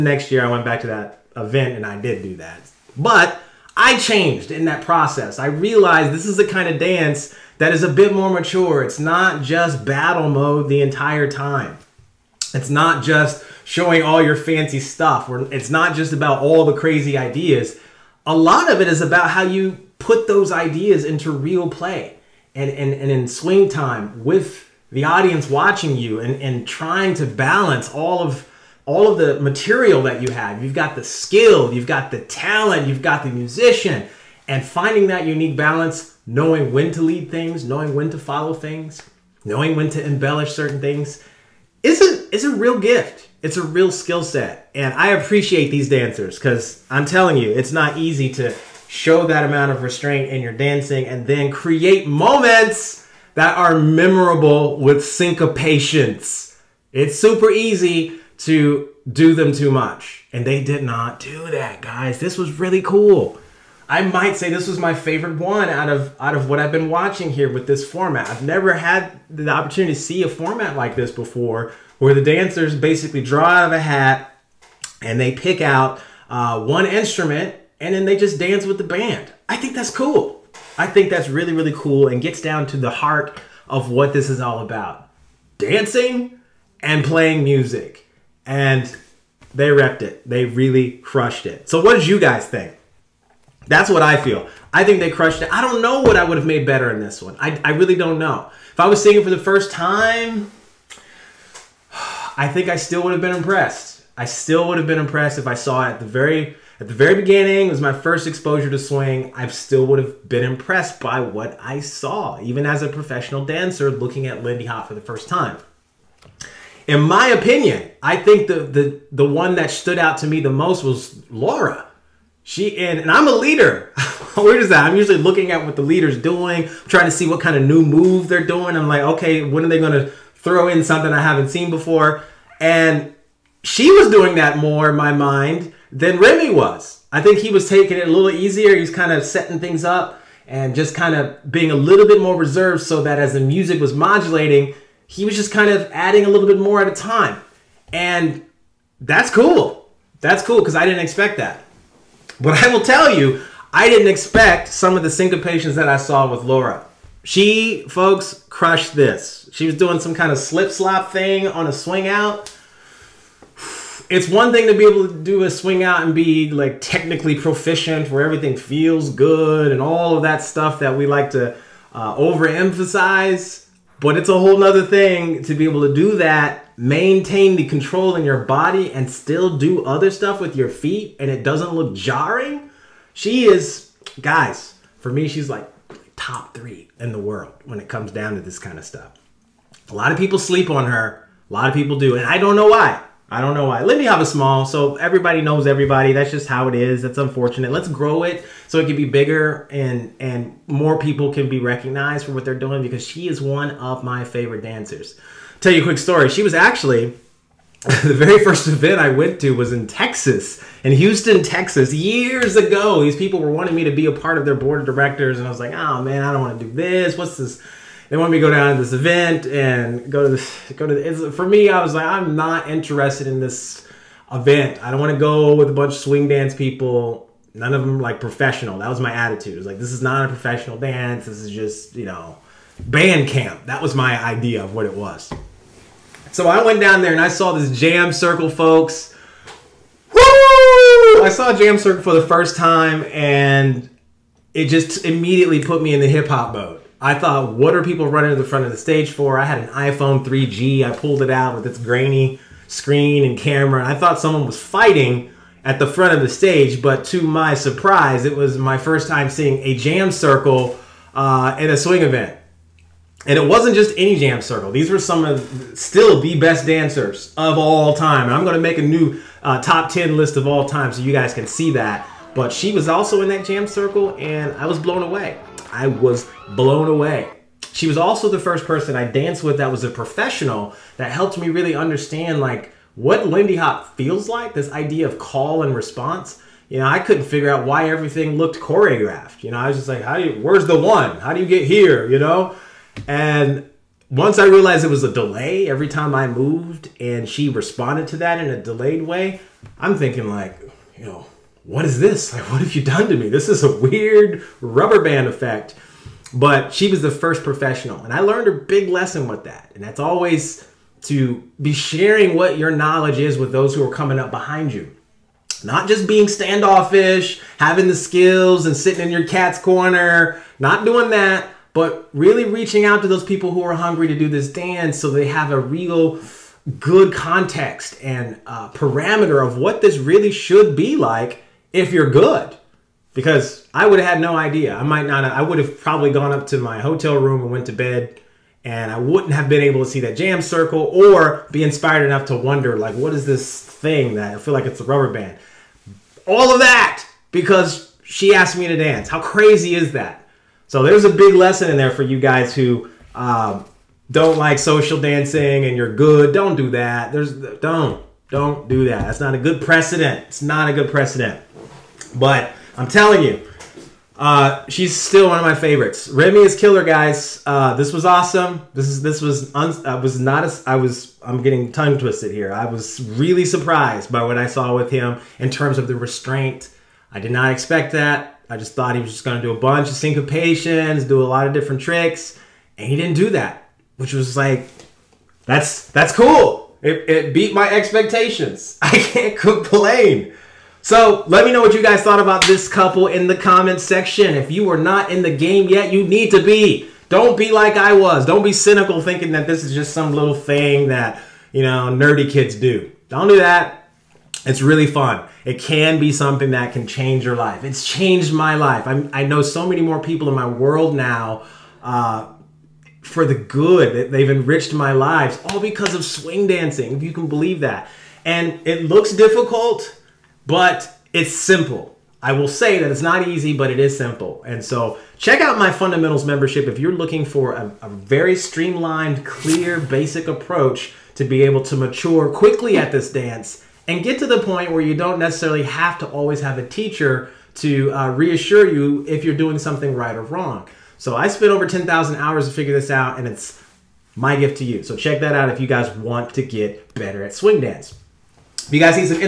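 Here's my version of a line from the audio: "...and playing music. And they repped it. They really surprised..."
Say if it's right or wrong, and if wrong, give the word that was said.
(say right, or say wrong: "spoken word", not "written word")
wrong: "crushed", not "surprised".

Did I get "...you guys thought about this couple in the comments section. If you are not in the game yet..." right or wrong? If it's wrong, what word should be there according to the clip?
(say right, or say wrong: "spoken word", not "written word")
right.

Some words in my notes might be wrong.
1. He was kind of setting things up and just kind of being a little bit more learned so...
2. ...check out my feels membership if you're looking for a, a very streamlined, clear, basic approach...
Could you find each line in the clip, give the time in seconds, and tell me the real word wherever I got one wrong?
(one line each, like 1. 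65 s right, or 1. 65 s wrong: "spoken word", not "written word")
1. 138 s wrong: "reserved", not "learned"
2. 425 s wrong: "fundamentals", not "feels".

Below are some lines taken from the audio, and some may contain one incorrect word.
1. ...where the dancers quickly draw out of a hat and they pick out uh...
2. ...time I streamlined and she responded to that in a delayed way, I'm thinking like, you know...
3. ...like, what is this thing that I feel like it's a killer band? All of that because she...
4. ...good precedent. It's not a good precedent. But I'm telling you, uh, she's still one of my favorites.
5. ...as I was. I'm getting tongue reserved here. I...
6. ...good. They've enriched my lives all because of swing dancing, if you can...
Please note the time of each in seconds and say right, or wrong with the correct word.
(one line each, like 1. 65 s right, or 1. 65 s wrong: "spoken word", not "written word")
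1. 71 s wrong: "basically", not "quickly"
2. 295 s wrong: "moved", not "streamlined"
3. 342 s wrong: "rubber", not "killer"
4. 359 s right
5. 370 s wrong: "twisted", not "reserved"
6. 413 s right.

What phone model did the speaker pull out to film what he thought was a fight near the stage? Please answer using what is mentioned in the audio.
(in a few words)
iPhone 3G.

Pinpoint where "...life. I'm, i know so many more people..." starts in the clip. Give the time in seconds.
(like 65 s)
408 s.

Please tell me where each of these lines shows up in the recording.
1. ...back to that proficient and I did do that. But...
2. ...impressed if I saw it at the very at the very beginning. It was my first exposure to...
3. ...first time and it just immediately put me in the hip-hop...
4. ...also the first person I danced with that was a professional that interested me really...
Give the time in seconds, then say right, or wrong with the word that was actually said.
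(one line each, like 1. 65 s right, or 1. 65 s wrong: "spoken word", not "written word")
1. 0 s wrong: "event", not "proficient"
2. 104 s right
3. 242 s right
4. 277 s wrong: "helped", not "interested".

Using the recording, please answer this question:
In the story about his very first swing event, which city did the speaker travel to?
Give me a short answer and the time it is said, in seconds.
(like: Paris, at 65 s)
Houston, at 210 s.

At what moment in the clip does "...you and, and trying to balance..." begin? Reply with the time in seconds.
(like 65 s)
25 s.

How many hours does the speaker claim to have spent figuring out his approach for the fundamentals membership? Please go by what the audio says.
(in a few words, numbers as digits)
10,000.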